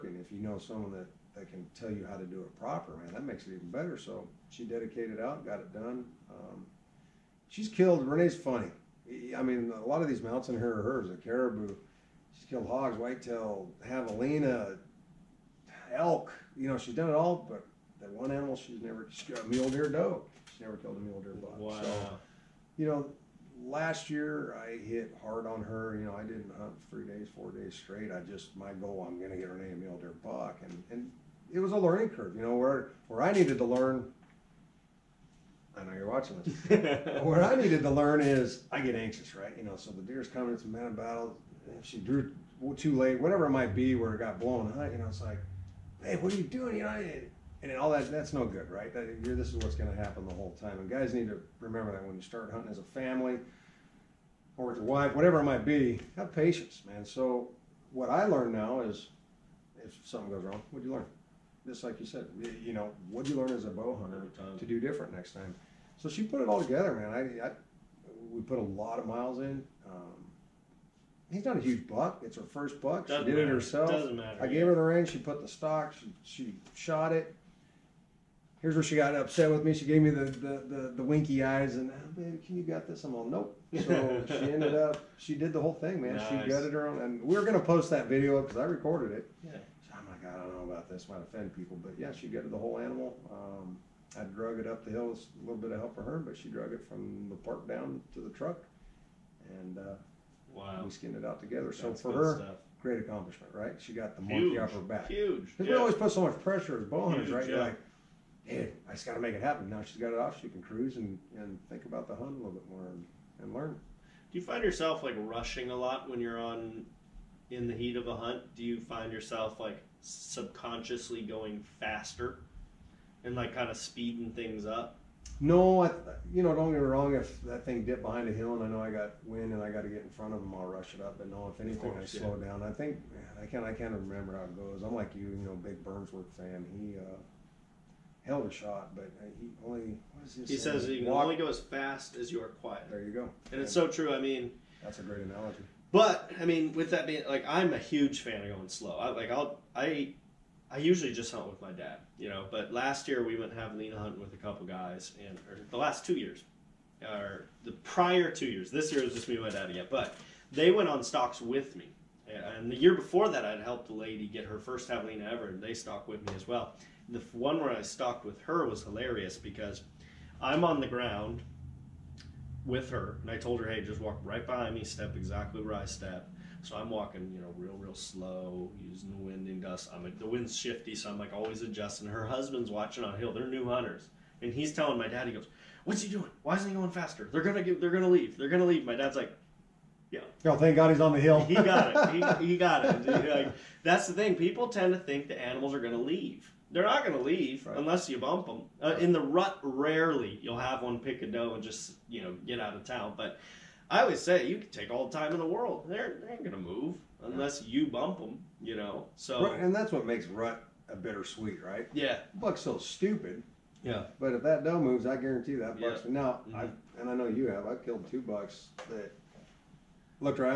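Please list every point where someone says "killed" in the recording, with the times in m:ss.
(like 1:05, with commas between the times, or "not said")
0:07, 0:12, 0:20, 3:37.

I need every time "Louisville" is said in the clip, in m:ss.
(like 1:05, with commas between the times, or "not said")
not said.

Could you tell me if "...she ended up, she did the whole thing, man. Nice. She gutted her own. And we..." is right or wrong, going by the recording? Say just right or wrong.
right.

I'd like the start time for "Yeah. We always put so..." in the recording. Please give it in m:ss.
1:45.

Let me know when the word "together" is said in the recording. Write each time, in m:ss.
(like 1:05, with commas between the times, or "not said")
1:06, 1:41.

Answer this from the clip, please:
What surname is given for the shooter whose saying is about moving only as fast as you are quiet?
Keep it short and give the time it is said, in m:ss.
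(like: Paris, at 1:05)
Burnsworth, at 2:15.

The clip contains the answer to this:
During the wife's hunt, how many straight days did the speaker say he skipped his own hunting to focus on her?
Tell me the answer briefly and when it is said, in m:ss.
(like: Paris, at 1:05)
4, at 0:27.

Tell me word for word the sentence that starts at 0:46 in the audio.
You know, and all that, that's no good, right?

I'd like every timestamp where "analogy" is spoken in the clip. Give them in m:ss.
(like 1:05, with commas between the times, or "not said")
2:25.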